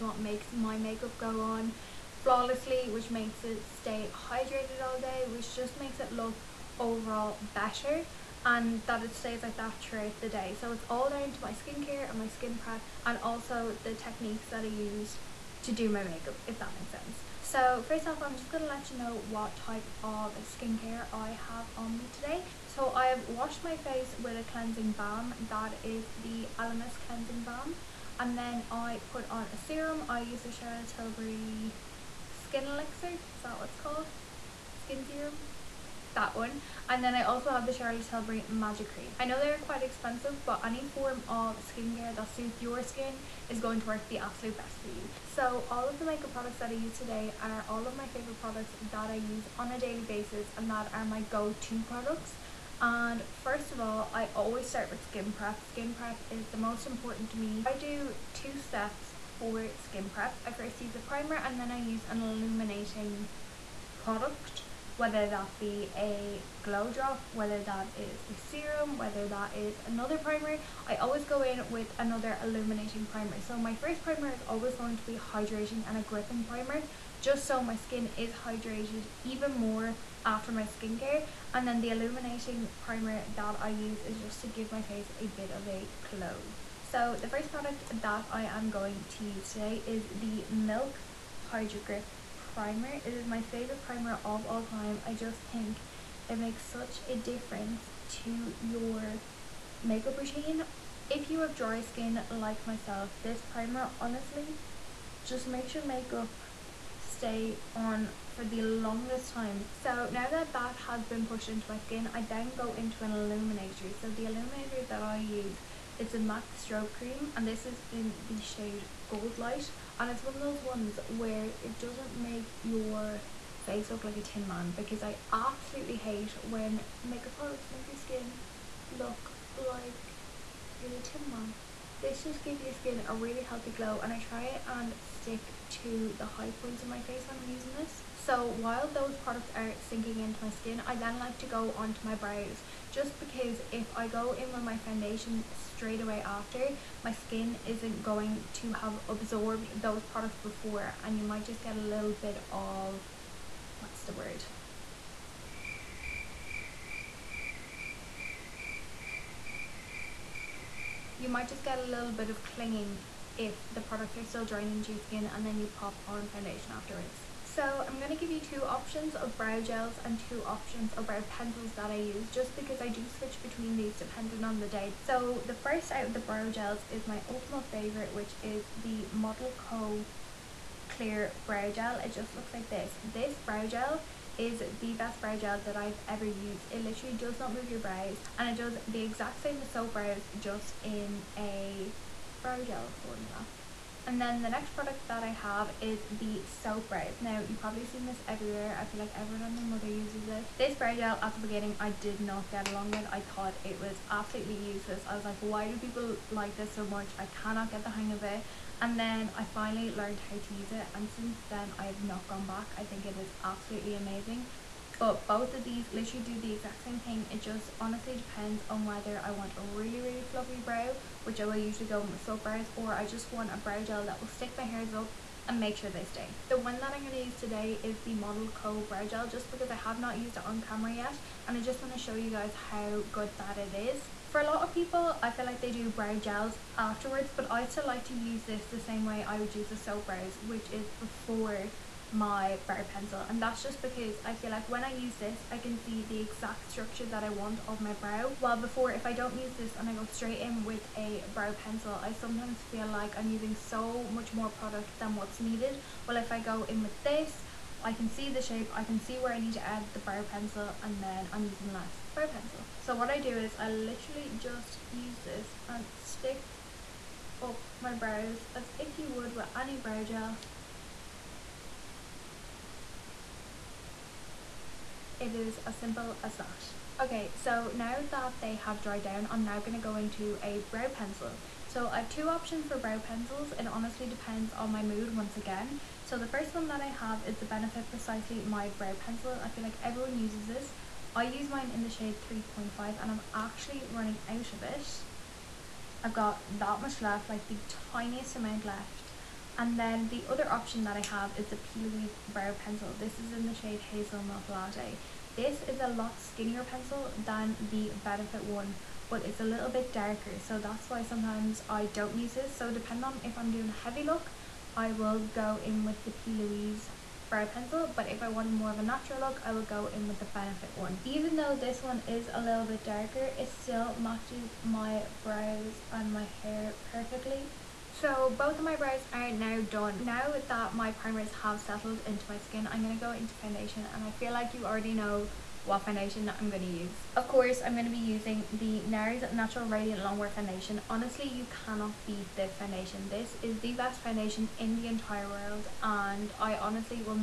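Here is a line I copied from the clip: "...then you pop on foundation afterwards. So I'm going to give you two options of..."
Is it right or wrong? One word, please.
right.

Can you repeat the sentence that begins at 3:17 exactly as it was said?
Now, you've probably seen this everywhere.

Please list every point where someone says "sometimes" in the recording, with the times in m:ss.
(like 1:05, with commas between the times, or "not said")
4:12, 5:11.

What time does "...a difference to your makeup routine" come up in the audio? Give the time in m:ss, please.
1:37.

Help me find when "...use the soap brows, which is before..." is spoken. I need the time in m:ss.
3:59.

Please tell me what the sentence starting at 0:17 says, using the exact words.
So first off, I'm just gonna let you know what type of skincare I have on me today.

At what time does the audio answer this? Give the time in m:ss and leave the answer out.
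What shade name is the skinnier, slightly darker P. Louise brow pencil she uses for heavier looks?
5:03.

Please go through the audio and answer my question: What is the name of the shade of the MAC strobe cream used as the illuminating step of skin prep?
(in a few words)
Goldlite.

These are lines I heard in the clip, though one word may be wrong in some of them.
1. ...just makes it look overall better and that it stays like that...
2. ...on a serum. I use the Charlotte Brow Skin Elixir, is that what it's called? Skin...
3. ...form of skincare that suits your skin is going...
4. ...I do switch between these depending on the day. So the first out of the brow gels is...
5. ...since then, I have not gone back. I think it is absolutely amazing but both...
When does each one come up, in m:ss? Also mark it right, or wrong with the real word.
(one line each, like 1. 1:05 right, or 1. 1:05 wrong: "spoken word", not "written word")
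1. 0:05 right
2. 0:29 wrong: "Tilbury", not "Brow"
3. 0:40 right
4. 2:52 right
5. 3:31 right.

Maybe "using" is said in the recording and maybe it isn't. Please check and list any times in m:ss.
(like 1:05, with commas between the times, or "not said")
2:17, 4:13, 4:21, 5:37.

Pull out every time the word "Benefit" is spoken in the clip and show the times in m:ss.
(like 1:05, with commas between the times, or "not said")
4:47, 5:08, 5:20.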